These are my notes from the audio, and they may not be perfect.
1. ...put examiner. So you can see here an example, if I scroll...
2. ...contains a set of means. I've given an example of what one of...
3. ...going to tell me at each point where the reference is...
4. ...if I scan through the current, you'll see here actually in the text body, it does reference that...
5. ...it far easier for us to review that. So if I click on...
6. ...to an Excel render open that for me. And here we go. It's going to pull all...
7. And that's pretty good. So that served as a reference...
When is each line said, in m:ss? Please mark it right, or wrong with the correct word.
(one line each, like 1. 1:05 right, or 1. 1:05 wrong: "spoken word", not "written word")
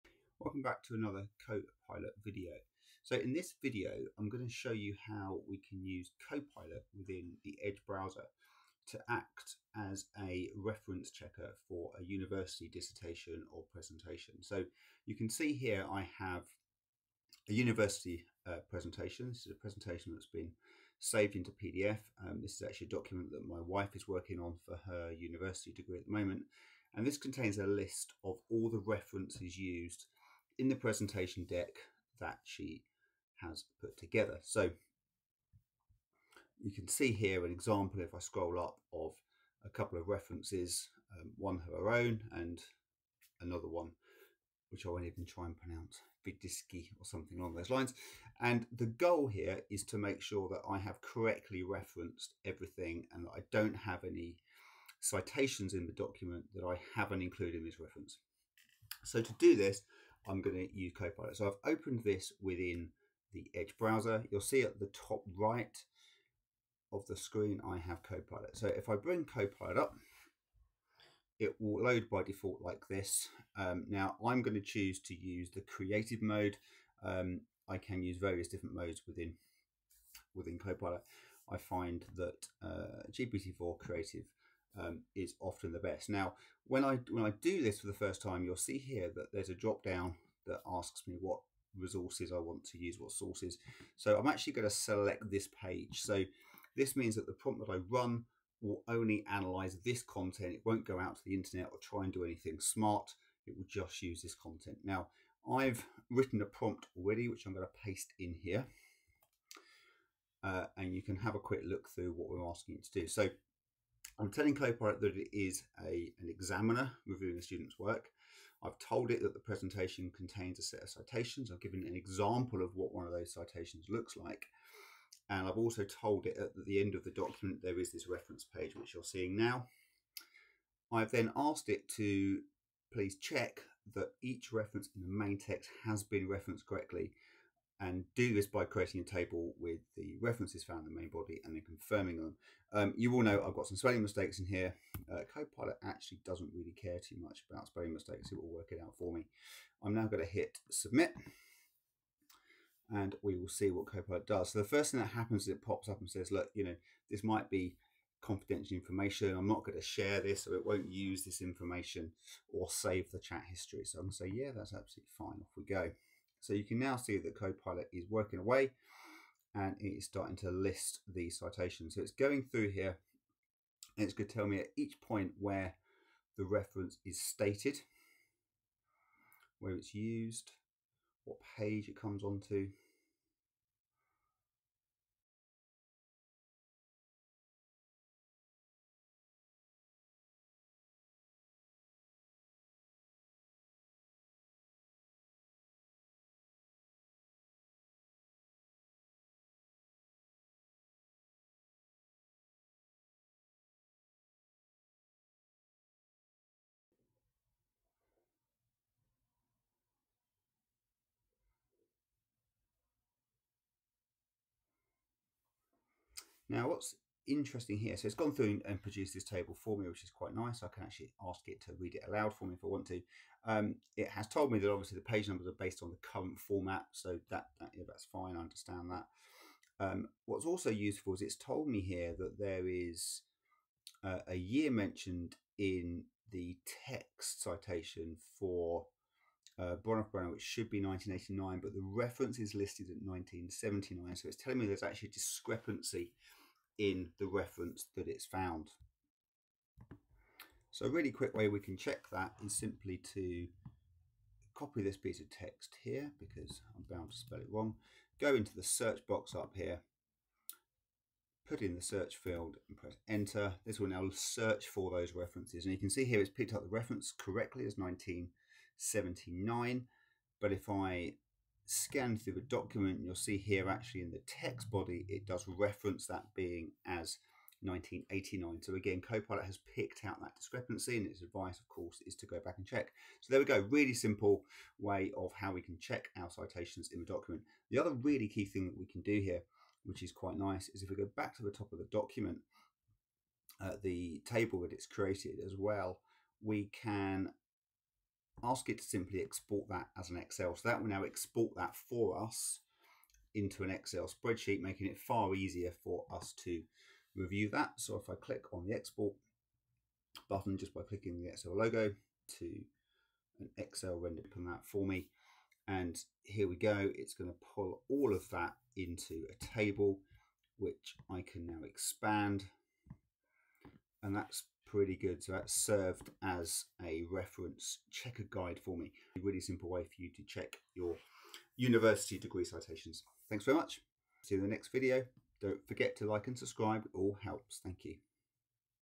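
1. 0:33 wrong: "together", not "examiner"
2. 2:00 wrong: "citations", not "means"
3. 2:54 right
4. 4:30 wrong: "document", not "current"
5. 5:04 right
6. 5:12 right
7. 5:24 right.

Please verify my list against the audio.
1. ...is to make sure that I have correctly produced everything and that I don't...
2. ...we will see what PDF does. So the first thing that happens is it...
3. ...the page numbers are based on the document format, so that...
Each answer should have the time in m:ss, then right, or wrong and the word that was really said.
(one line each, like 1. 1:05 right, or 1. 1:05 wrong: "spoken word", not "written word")
1. 0:49 wrong: "referenced", not "produced"
2. 2:33 wrong: "Copilot", not "PDF"
3. 3:44 wrong: "current", not "document".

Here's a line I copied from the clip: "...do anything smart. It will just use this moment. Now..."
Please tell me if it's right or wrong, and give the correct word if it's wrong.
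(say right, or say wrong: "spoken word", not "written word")
wrong: "content", not "moment".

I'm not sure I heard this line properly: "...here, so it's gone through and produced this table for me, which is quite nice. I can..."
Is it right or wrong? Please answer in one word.
right.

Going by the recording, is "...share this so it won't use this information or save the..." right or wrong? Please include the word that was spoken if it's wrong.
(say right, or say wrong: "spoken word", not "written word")
right.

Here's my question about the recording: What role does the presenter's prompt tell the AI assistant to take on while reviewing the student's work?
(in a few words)
Examiner.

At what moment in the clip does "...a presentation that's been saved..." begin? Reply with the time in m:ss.
0:19.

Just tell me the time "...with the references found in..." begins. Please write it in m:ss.
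2:19.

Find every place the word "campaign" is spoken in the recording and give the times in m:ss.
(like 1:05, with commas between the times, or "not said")
not said.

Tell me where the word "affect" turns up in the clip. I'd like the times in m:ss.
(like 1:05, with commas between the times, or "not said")
not said.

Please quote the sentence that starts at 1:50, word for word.
Uh, and you can have a quick look through what we're asking it to do.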